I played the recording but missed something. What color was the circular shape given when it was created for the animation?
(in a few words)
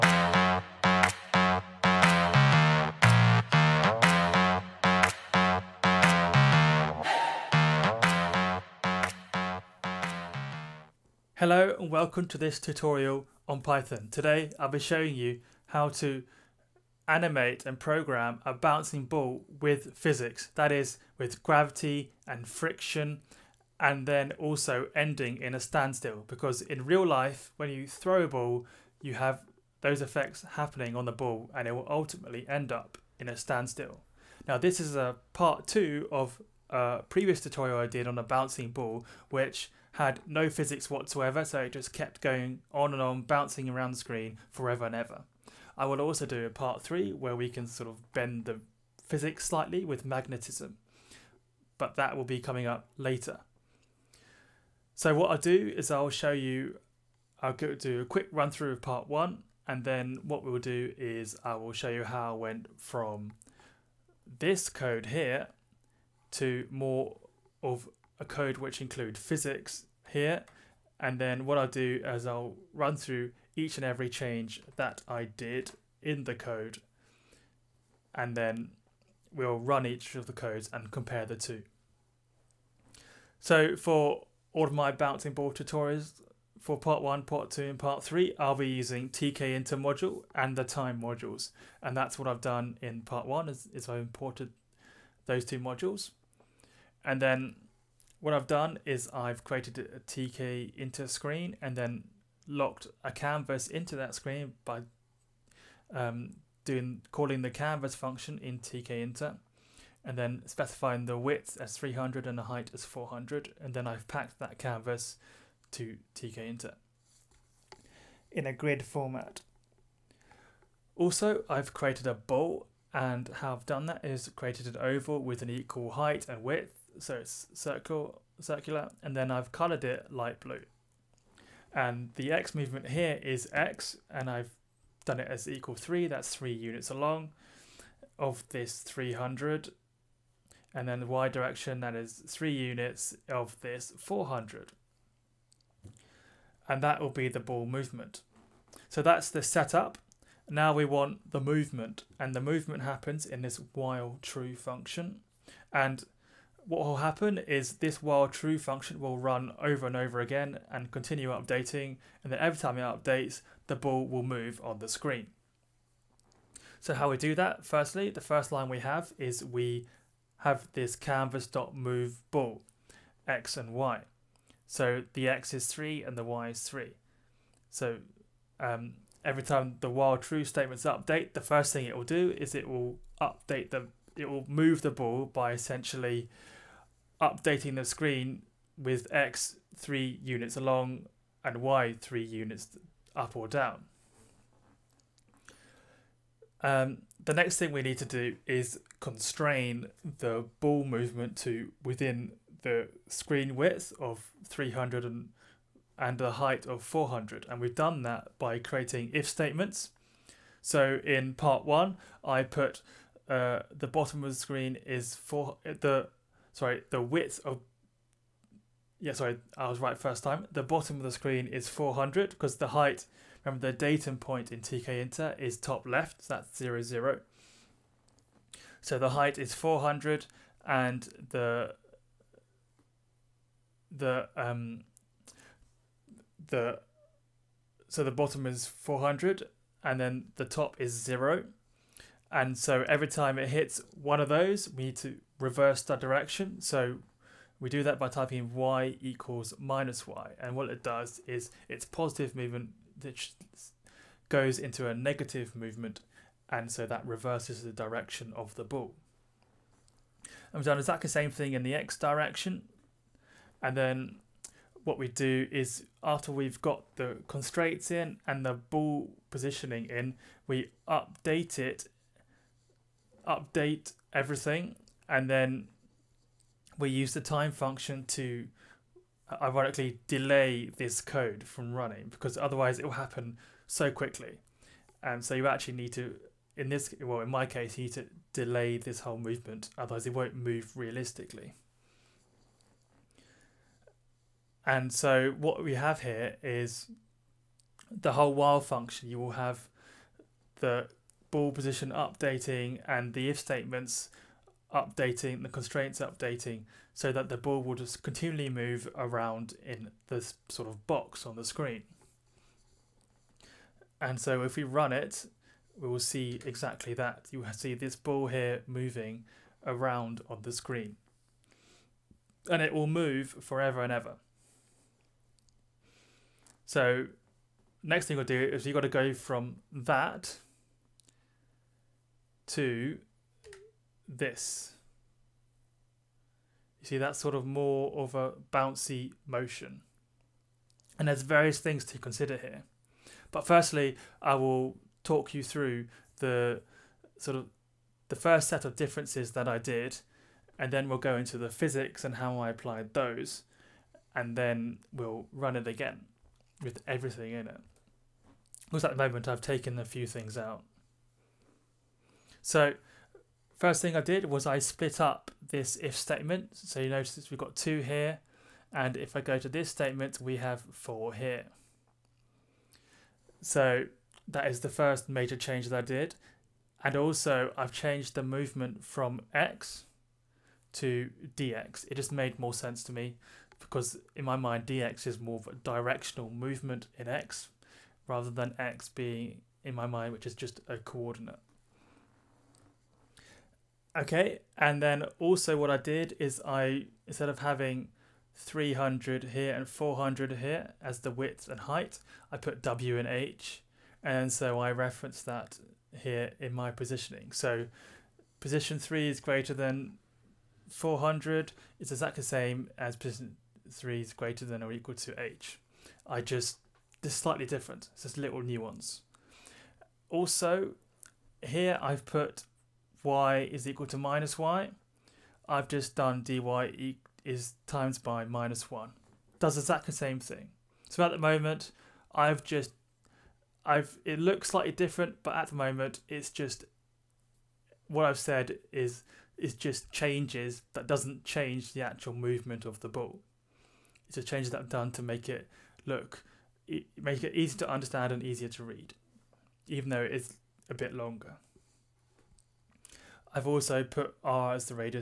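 Light blue.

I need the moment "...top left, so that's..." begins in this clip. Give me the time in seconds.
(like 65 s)
225 s.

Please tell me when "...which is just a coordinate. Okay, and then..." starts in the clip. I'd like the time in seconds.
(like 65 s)
390 s.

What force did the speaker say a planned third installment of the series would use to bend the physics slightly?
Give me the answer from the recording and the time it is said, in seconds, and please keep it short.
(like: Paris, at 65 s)
Magnetism, at 50 s.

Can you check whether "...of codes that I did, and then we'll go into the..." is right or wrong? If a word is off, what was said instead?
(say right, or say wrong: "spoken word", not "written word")
wrong: "differences", not "codes".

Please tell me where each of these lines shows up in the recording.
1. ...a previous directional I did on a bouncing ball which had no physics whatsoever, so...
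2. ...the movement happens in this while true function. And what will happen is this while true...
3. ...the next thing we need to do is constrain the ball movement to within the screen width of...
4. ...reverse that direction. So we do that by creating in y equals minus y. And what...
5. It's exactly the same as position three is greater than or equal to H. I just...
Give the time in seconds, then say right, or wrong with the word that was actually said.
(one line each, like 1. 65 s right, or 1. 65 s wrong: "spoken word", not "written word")
1. 36 s wrong: "tutorial", not "directional"
2. 152 s right
3. 197 s right
4. 245 s wrong: "typing", not "creating"
5. 411 s right.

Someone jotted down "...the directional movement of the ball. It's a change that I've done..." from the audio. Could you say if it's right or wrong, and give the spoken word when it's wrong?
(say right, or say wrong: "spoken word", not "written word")
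wrong: "actual", not "directional".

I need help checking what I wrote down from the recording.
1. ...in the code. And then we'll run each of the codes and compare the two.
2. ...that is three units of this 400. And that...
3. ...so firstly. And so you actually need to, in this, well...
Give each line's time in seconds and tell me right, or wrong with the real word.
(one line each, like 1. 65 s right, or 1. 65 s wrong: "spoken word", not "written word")
1. 76 s right
2. 141 s right
3. 283 s wrong: "quickly", not "firstly".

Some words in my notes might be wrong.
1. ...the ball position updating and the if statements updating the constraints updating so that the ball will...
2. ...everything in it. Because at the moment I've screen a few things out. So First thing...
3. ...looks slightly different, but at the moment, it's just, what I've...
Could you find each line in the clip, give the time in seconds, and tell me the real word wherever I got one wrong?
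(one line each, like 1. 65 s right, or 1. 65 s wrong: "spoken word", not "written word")
1. 300 s right
2. 356 s wrong: "taken", not "screen"
3. 434 s right.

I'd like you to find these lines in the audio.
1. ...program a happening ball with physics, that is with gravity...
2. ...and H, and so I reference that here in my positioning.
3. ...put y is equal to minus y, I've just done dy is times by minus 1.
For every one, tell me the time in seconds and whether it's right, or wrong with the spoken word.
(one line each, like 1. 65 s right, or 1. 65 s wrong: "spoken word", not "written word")
1. 17 s wrong: "bouncing", not "happening"
2. 402 s right
3. 422 s right.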